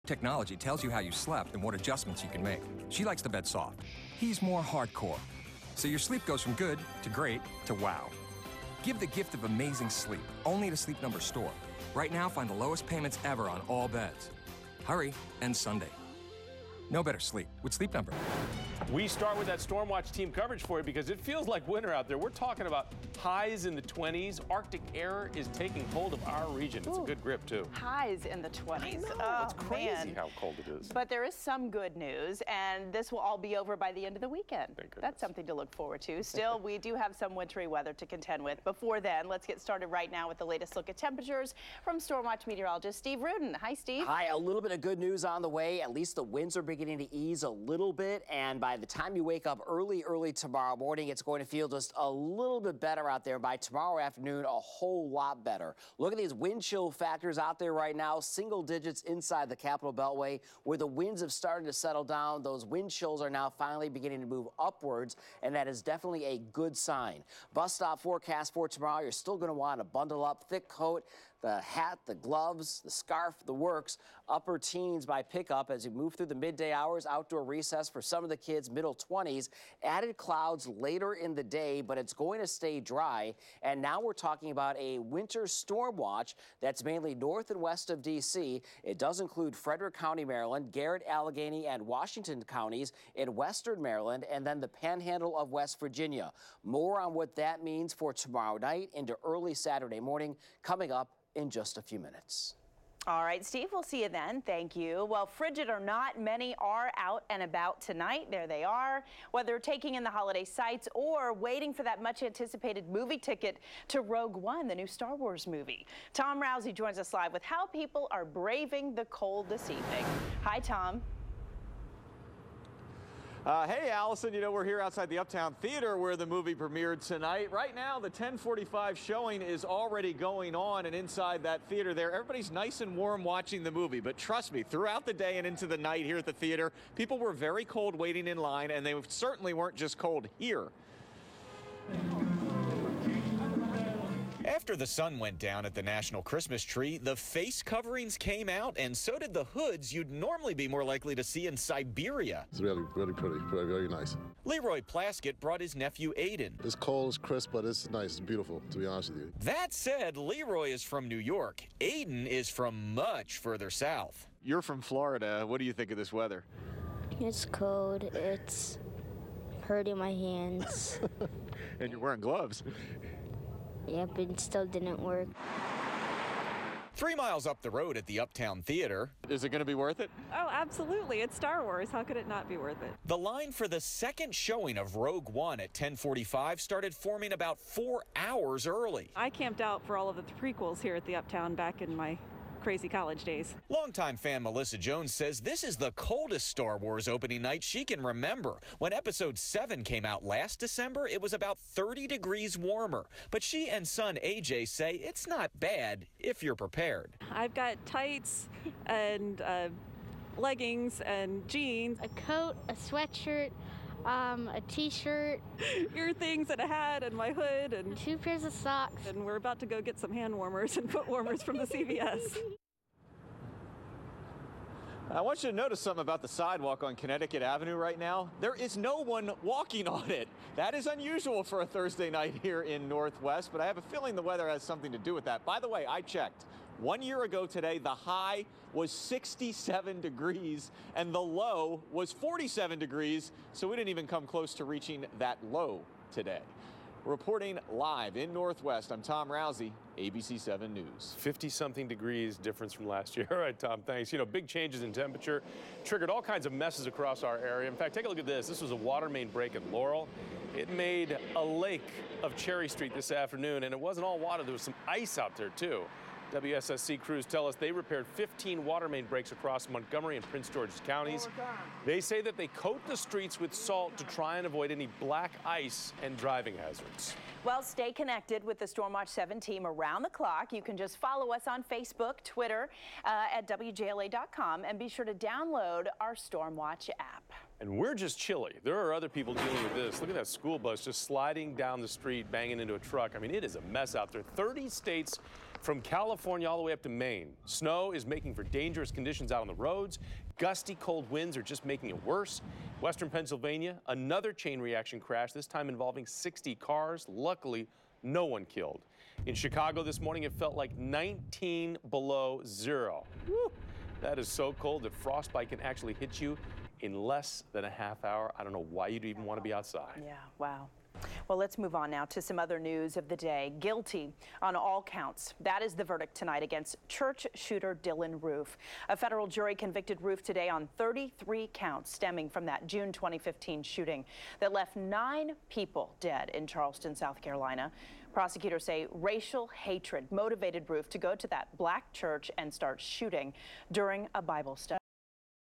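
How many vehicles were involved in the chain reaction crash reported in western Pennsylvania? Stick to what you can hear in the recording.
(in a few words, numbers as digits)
60.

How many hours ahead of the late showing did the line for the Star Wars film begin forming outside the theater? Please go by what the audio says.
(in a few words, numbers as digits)
4.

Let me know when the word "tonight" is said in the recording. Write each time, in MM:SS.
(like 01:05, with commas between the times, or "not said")
01:47, 02:07, 05:26.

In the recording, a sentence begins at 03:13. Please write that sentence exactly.
Longtime fan Melissa Jones says this is the coldest Star Wars opening night she can remember.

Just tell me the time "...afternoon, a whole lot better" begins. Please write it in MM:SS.
00:53.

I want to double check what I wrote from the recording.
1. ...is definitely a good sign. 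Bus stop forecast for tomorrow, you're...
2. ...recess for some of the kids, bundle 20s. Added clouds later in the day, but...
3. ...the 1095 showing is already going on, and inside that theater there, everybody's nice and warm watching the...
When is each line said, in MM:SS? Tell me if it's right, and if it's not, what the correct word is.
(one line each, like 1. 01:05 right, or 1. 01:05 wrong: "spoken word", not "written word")
1. 01:05 right
2. 01:17 wrong: "middle", not "bundle"
3. 02:07 wrong: "1045", not "1095".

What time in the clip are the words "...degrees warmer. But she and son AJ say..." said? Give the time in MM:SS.
03:22.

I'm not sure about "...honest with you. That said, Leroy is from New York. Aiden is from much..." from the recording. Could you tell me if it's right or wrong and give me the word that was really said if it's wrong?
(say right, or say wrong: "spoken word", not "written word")
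right.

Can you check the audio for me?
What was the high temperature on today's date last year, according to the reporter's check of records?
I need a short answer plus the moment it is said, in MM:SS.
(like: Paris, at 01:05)
67 degrees, at 03:58.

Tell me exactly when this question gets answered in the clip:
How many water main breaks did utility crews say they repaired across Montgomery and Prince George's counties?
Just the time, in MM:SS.
04:28.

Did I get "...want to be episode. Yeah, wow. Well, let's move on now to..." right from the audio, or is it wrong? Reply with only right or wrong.
wrong.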